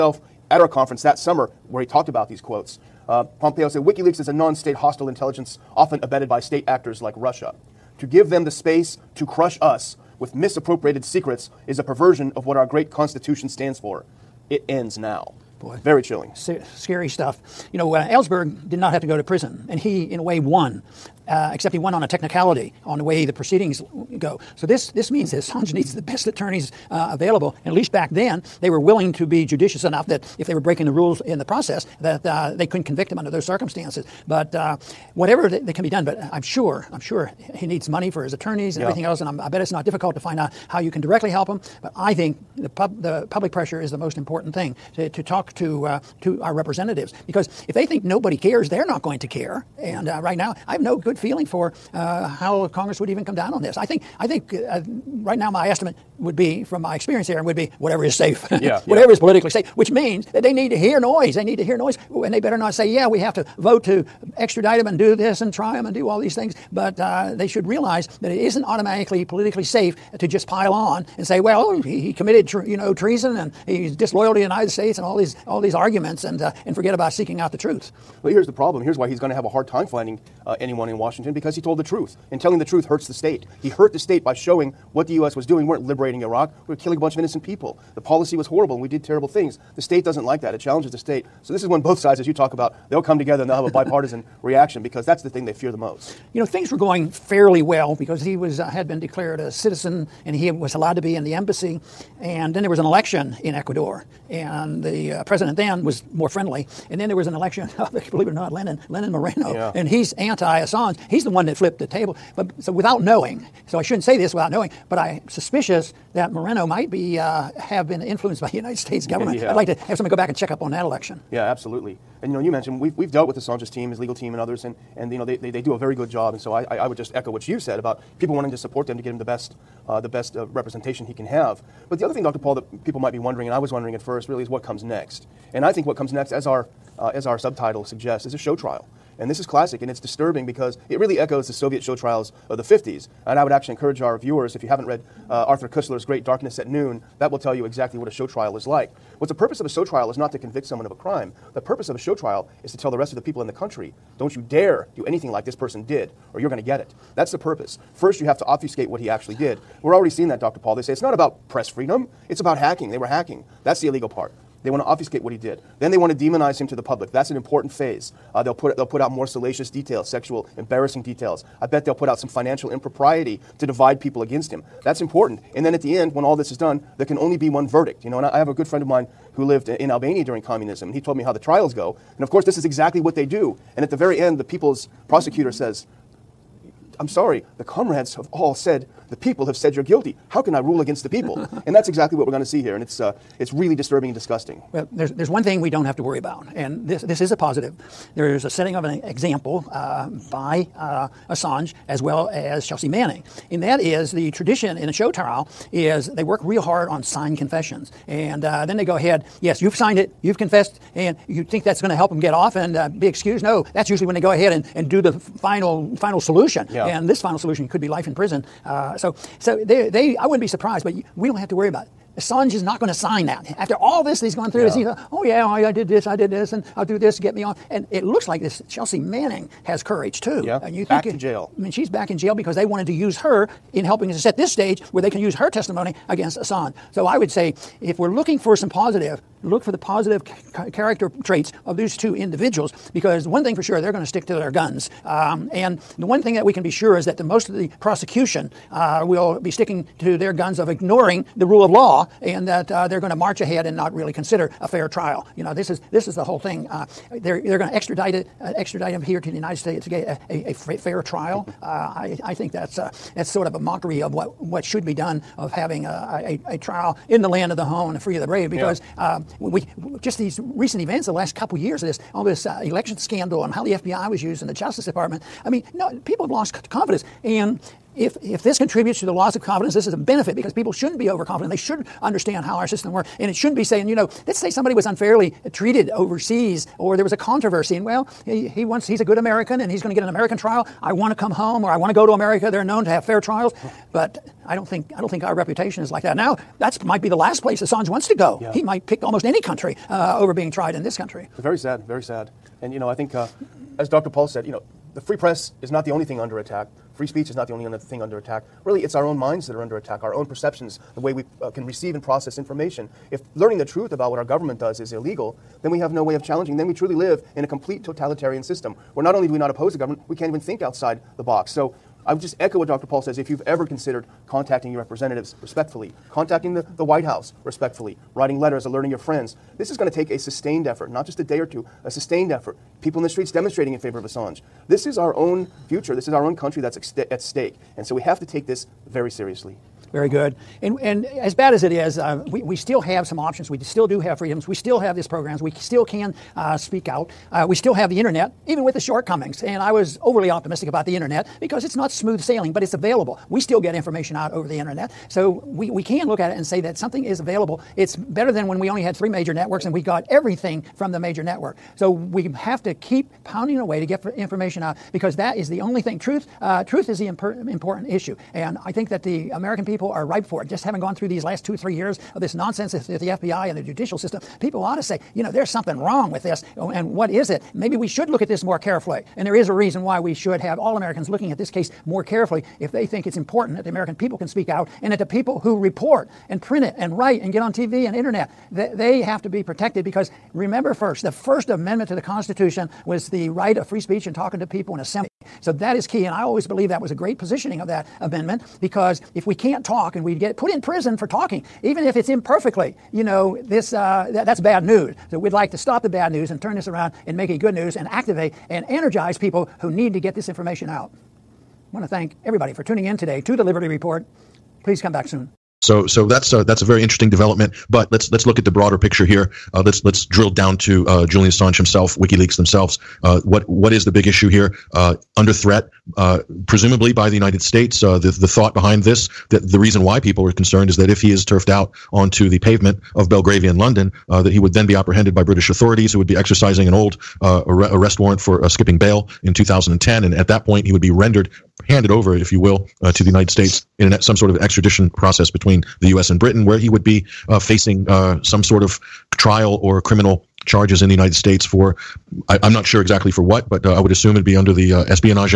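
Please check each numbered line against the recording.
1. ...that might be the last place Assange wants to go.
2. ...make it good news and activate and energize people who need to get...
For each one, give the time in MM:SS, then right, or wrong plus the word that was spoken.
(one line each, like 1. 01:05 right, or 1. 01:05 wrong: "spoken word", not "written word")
1. 04:56 right
2. 06:47 right.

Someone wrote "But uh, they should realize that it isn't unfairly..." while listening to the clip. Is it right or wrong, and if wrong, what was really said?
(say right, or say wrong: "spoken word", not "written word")
wrong: "automatically", not "unfairly".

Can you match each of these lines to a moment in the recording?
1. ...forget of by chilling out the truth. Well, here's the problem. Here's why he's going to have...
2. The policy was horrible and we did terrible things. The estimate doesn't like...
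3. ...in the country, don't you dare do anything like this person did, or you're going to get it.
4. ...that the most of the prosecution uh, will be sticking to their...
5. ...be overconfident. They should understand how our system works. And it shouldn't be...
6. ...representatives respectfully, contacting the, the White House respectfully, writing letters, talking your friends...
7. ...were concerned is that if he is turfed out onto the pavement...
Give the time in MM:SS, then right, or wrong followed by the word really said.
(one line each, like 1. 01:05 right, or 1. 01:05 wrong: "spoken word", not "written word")
1. 01:16 wrong: "seeking", not "chilling"
2. 01:27 wrong: "state", not "estimate"
3. 02:33 right
4. 04:07 right
5. 04:40 right
6. 05:24 wrong: "alerting", not "talking"
7. 07:10 right.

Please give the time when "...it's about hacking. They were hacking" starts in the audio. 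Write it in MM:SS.
02:42.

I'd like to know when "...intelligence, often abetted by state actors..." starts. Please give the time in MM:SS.
00:05.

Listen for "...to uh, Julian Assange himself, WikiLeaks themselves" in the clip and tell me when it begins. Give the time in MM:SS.
07:00.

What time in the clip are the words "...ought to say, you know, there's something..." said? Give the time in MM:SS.
06:14.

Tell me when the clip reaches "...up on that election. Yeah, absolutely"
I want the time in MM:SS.
02:00.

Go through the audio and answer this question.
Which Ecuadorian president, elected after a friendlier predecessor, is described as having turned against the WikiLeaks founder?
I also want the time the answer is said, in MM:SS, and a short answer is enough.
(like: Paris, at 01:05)
Lenin Moreno, at 01:48.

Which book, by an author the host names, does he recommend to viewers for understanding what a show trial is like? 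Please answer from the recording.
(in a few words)
Darkness at Noon.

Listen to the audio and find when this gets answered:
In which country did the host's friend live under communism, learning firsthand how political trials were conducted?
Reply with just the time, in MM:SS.
02:59.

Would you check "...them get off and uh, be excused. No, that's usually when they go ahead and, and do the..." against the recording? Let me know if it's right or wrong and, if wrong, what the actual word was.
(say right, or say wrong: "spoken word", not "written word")
right.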